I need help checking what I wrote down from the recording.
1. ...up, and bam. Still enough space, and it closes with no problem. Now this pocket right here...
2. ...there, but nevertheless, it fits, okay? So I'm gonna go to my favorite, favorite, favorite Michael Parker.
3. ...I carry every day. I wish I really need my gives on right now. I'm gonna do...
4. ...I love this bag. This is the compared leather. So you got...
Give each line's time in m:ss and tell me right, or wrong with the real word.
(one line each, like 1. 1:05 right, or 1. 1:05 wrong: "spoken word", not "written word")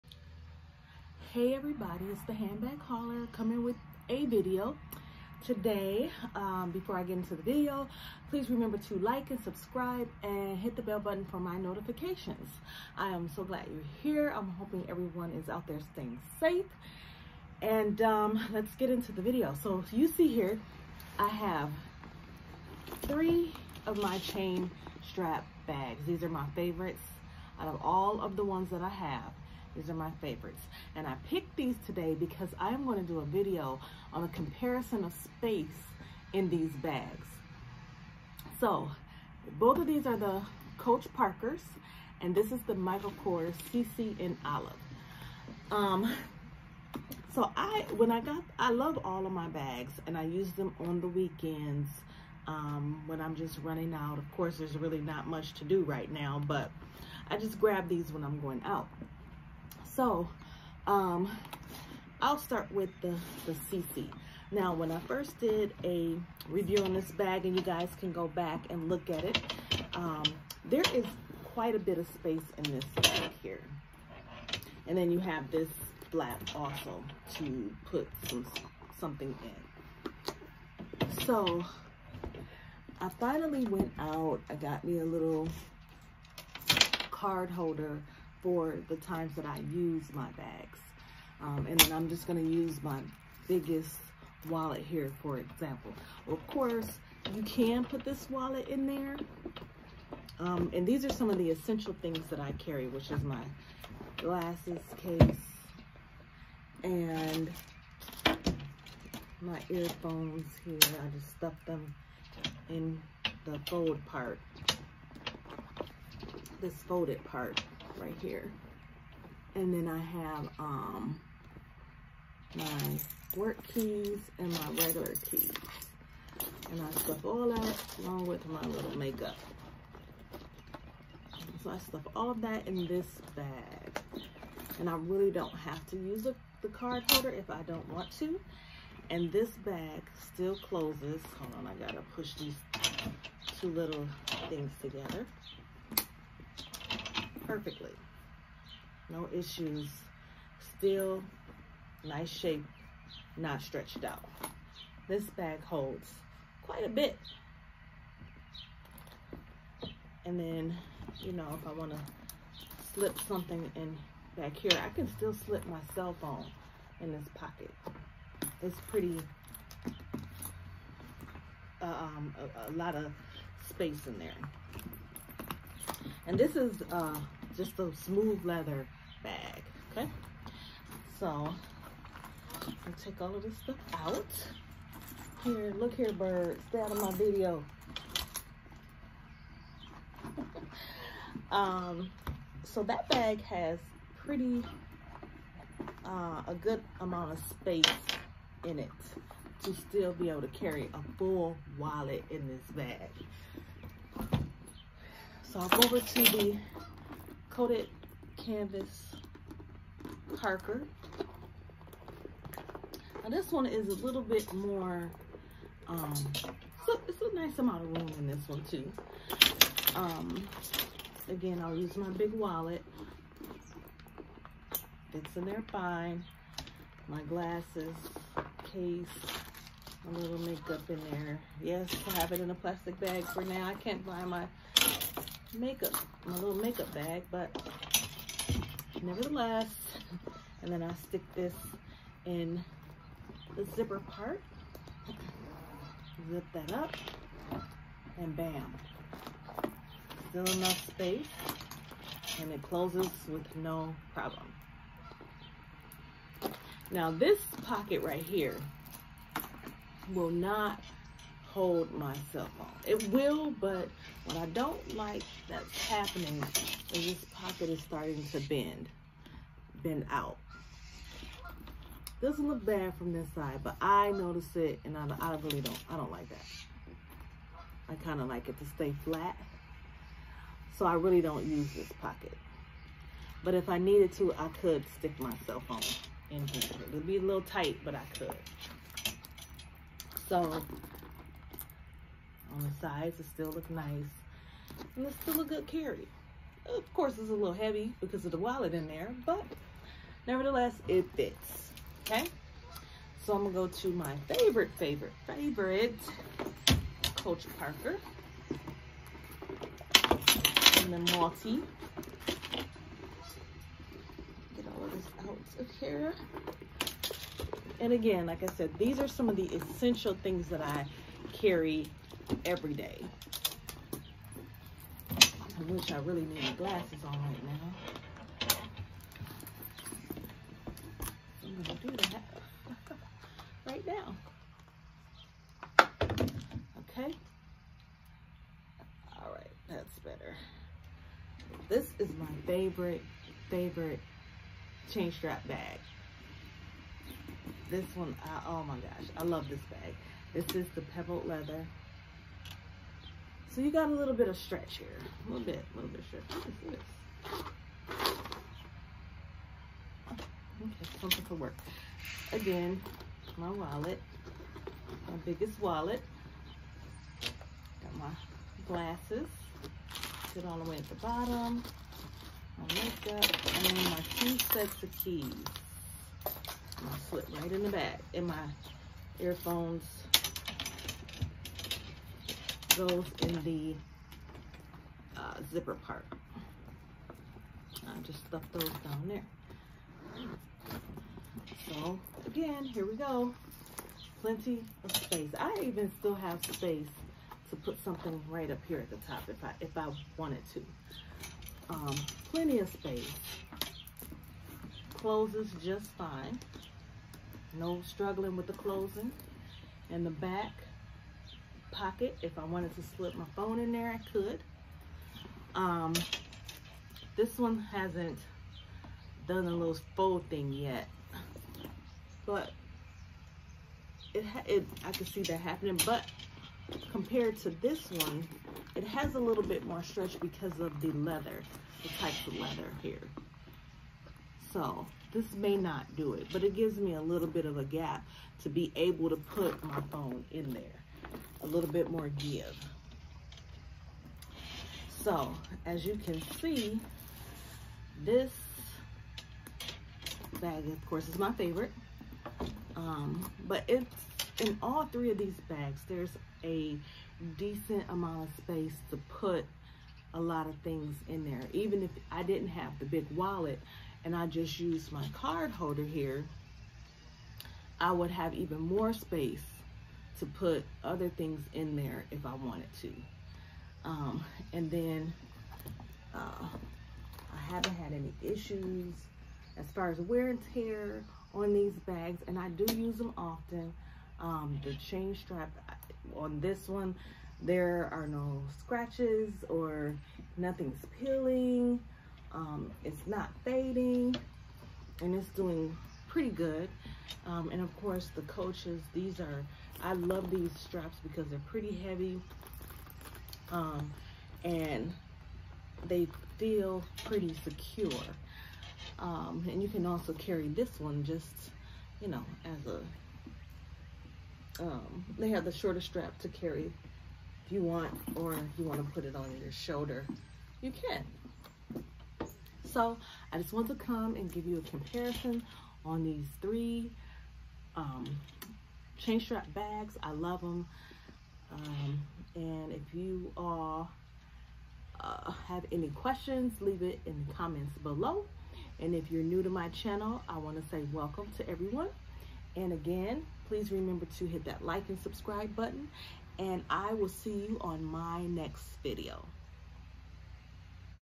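1. 4:06 right
2. 4:58 wrong: "Coach", not "Michael"
3. 5:20 wrong: "glasses", not "gives"
4. 5:49 wrong: "pebbled", not "compared".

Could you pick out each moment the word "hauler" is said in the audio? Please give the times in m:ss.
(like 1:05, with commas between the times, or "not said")
0:02.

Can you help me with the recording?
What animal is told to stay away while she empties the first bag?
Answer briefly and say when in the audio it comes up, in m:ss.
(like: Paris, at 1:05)
bird, at 3:06.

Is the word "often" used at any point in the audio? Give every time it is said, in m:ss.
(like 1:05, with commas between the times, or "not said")
8:03.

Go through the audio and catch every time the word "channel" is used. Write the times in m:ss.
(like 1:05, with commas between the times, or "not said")
8:59.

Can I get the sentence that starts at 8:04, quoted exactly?
Um, the chain strap on this one, there are no scratches or nothing's peeling.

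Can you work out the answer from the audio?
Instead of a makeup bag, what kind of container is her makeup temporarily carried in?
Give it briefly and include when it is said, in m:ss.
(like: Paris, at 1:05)
plastic bag, at 3:52.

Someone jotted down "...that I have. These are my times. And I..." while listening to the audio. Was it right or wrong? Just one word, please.
wrong.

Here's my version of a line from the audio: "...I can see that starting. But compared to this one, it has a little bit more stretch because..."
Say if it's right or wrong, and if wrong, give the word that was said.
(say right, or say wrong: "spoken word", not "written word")
wrong: "happening", not "starting".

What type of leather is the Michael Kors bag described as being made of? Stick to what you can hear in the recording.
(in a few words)
smooth leather.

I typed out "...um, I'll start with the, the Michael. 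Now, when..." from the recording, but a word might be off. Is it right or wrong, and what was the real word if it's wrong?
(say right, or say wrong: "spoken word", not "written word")
wrong: "Cece", not "Michael".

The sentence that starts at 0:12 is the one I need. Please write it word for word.
I am so glad you're here.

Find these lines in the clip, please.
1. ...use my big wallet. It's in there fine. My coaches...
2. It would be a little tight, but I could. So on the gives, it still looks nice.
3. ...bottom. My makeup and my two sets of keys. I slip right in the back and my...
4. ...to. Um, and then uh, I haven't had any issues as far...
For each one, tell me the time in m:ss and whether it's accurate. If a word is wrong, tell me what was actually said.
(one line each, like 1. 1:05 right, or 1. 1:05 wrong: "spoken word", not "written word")
1. 3:41 wrong: "glasses", not "coaches"
2. 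4:46 wrong: "sides", not "gives"
3. 6:10 right
4. 7:52 right.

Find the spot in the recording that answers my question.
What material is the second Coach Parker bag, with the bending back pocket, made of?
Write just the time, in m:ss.
3:27.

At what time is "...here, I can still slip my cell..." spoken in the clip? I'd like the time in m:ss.
2:44.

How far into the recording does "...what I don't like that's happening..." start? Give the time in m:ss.
4:24.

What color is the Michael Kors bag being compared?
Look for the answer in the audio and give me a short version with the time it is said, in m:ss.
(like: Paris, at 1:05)
Olive, at 0:44.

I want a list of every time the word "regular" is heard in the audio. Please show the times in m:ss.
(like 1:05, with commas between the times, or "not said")
2:04.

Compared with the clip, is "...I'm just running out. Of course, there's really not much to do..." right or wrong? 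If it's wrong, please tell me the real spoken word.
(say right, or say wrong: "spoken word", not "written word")
right.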